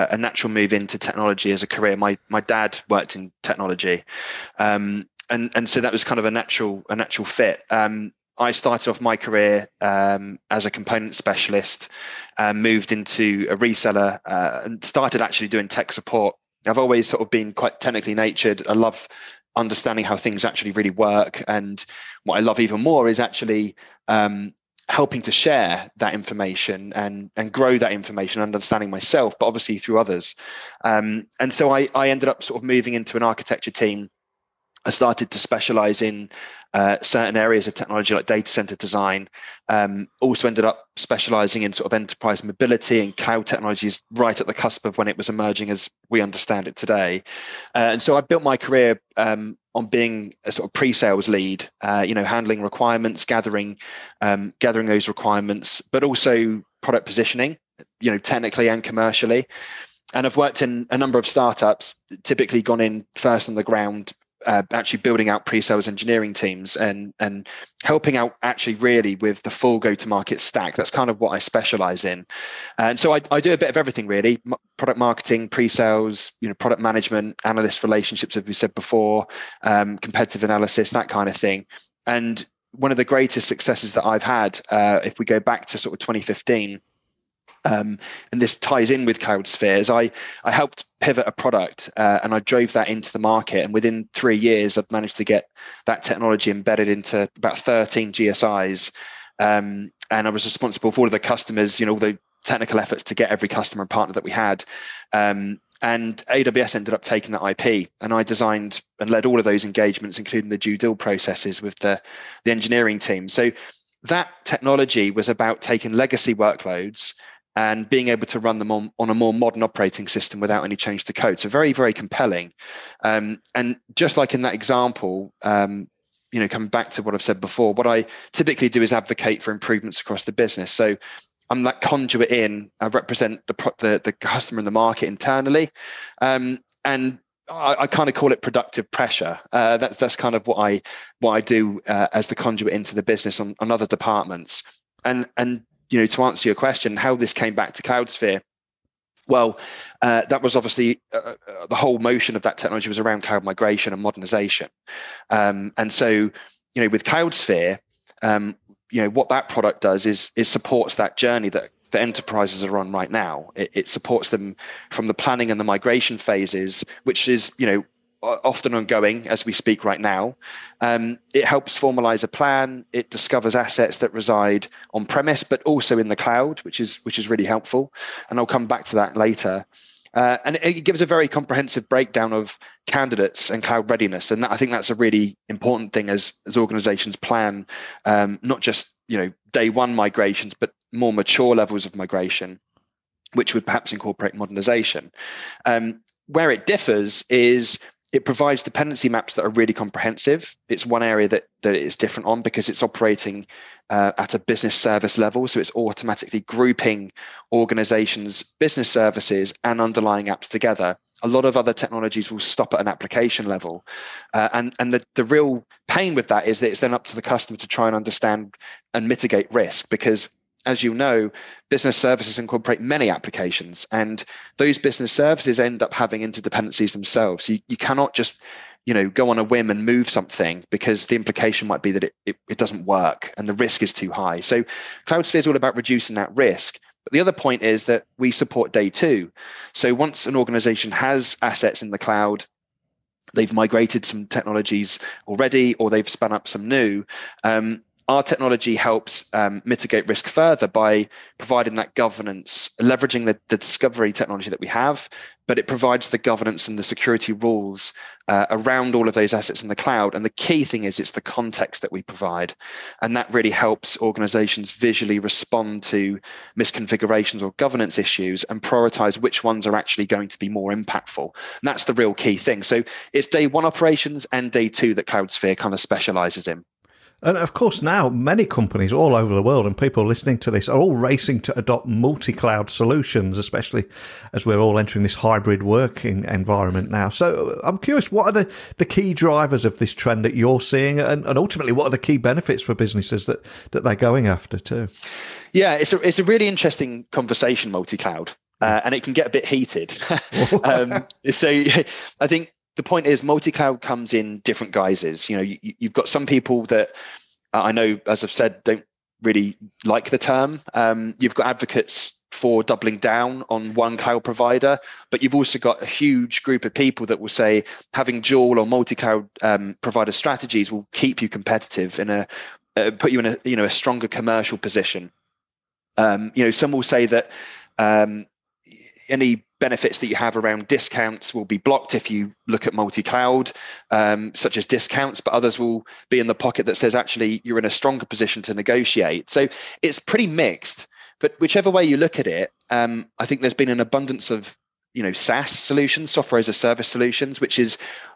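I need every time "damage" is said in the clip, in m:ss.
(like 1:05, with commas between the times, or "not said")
not said.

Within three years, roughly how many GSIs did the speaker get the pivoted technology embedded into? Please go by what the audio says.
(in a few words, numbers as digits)
13.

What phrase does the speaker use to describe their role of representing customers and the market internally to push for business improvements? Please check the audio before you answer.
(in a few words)
Productive pressure.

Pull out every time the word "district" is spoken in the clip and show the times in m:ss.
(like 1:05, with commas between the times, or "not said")
not said.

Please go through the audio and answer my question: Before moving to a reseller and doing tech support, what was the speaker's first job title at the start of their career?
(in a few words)
Component specialist.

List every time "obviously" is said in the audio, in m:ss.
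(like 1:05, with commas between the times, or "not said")
0:29, 2:30.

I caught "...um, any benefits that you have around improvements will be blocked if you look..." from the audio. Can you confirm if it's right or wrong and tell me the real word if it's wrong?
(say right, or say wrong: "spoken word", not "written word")
wrong: "discounts", not "improvements".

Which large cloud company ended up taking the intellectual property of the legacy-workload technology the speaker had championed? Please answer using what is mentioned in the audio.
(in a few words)
AWS.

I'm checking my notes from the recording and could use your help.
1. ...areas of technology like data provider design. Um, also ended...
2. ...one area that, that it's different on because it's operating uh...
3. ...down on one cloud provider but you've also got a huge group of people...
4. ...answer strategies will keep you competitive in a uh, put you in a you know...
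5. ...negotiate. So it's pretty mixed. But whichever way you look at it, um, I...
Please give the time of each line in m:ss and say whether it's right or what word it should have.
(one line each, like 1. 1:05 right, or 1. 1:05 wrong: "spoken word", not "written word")
1. 0:37 wrong: "center", not "provider"
2. 3:20 right
3. 5:12 right
4. 5:19 wrong: "provider", not "answer"
5. 5:38 right.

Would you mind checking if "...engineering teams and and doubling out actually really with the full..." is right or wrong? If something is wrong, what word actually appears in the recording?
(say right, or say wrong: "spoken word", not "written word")
wrong: "helping", not "doubling".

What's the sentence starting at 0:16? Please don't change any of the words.
I've always sort of been quite technically natured.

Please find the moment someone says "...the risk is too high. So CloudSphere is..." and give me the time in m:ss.
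3:53.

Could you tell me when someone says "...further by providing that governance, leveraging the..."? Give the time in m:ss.
4:10.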